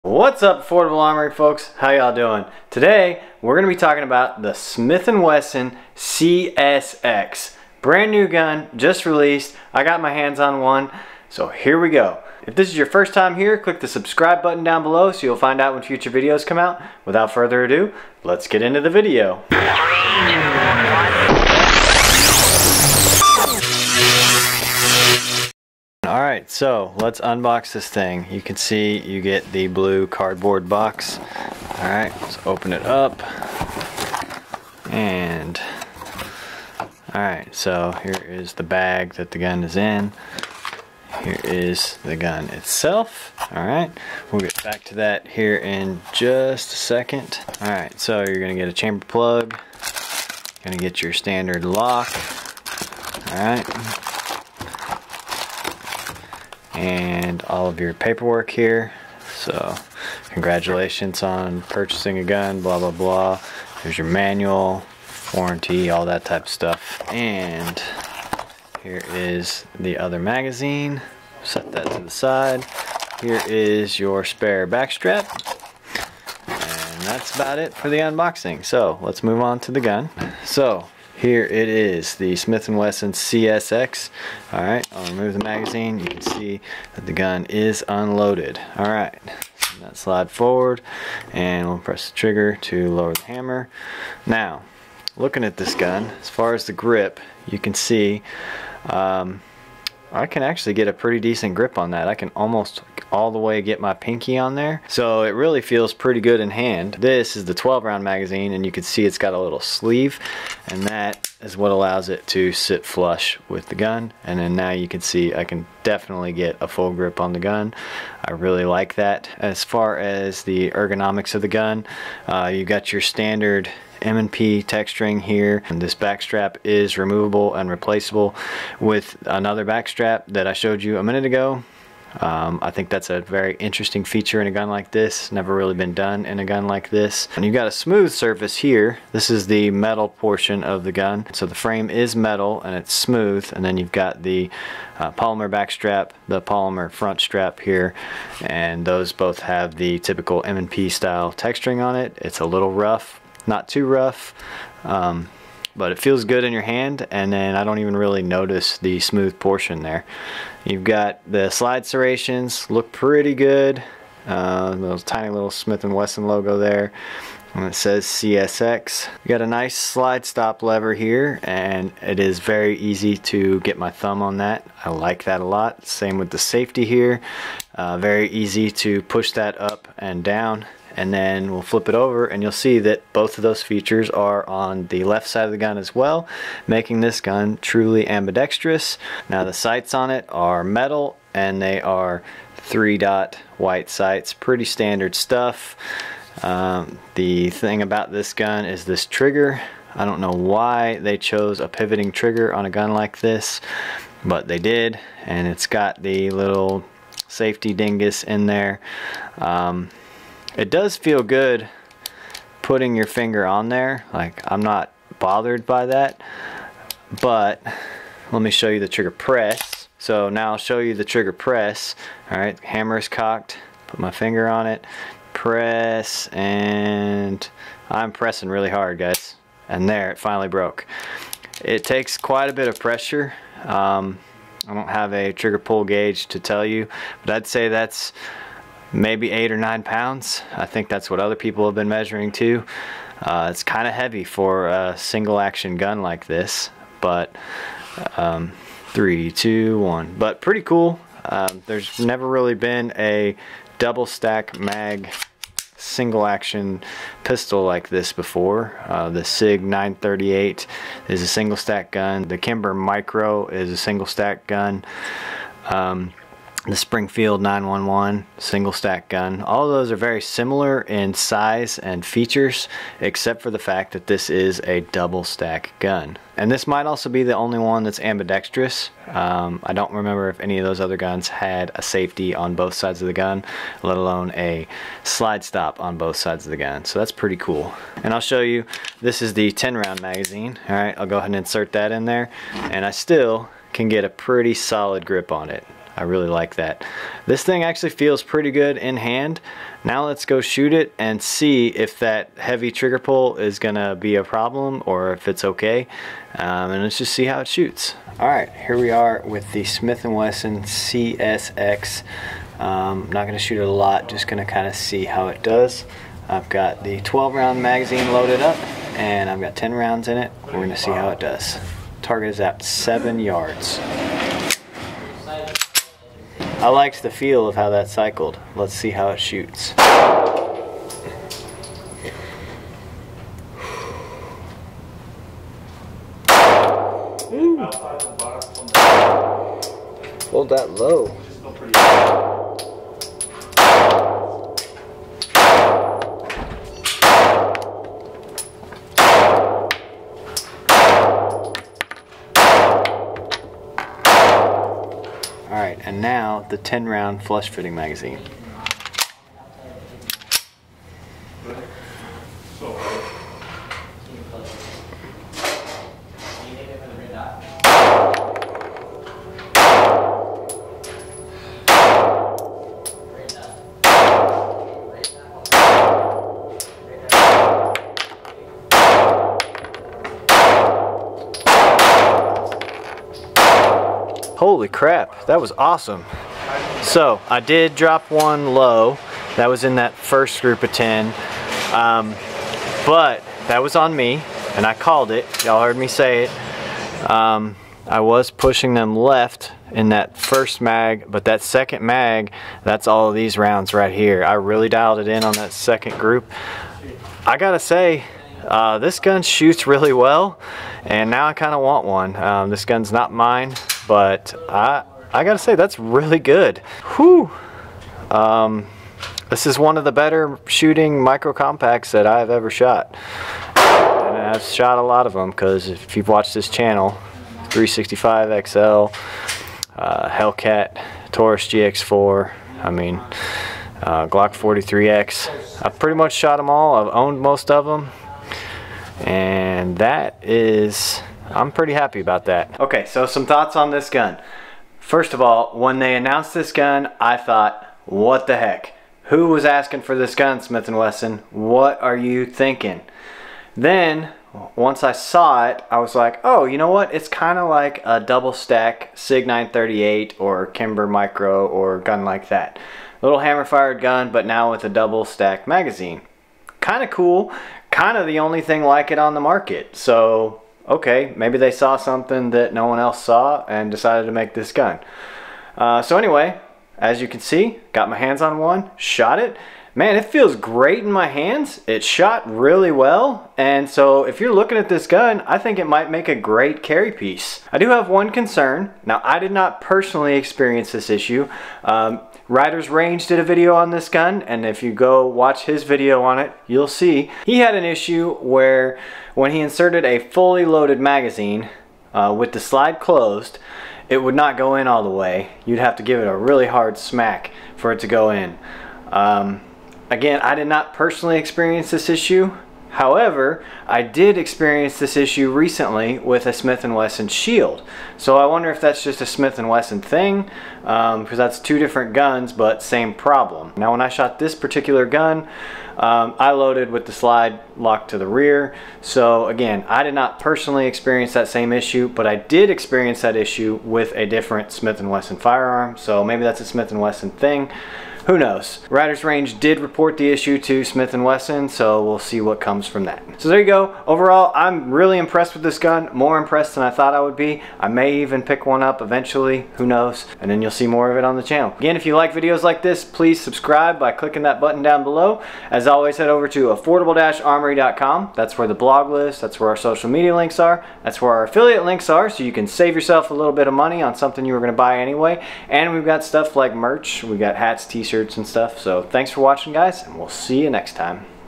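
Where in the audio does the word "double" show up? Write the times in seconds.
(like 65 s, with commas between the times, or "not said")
253 s, 274 s, 458 s, 464 s.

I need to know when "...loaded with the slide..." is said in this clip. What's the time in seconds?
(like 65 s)
526 s.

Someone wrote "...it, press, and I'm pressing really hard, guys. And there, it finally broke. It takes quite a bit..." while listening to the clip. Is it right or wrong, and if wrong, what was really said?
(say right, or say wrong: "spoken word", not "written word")
right.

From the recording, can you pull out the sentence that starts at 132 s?
Um, I think that's a very interesting feature in a gun like this.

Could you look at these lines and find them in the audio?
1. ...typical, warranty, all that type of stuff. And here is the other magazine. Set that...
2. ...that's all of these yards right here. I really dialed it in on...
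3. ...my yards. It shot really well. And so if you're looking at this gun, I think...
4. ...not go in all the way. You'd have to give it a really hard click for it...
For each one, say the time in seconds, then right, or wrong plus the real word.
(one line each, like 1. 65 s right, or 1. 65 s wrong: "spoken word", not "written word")
1. 64 s wrong: "manual", not "typical"
2. 402 s wrong: "rounds", not "yards"
3. 480 s wrong: "hands", not "yards"
4. 504 s wrong: "smack", not "click".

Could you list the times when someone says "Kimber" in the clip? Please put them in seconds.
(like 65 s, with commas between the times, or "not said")
262 s, 460 s.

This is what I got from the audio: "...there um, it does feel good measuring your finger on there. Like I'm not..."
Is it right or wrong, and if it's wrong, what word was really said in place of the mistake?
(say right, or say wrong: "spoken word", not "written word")
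wrong: "putting", not "measuring".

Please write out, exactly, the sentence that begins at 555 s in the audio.
As always, head over to affordable-armory.com.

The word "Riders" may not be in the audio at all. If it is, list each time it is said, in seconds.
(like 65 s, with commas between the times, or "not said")
492 s, 538 s.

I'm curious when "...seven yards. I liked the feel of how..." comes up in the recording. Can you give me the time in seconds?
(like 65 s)
322 s.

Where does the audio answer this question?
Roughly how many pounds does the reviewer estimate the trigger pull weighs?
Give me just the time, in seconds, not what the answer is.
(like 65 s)
239 s.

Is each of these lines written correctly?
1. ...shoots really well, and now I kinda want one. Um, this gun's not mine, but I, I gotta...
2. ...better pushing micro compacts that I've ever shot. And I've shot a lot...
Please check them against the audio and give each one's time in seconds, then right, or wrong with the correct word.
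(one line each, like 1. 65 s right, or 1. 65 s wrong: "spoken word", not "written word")
1. 409 s right
2. 419 s wrong: "shooting", not "pushing".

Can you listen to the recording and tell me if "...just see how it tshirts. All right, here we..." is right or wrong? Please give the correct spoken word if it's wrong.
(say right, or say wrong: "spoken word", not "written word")
wrong: "shoots", not "tshirts".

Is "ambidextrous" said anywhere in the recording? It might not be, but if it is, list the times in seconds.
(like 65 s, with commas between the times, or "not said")
188 s, 277 s.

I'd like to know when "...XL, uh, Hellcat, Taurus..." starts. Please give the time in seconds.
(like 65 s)
428 s.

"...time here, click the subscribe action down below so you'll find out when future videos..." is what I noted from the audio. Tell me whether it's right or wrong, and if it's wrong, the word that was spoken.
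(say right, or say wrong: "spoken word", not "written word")
wrong: "button", not "action".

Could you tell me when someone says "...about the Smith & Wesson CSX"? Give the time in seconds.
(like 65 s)
4 s.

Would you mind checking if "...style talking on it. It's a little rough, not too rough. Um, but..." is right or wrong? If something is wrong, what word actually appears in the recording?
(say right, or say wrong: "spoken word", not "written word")
wrong: "texturing", not "talking".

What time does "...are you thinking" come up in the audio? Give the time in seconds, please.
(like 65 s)
451 s.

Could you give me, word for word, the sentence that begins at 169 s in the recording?
You got a nice slide stop lever here and it is very easy to get my thumb on that.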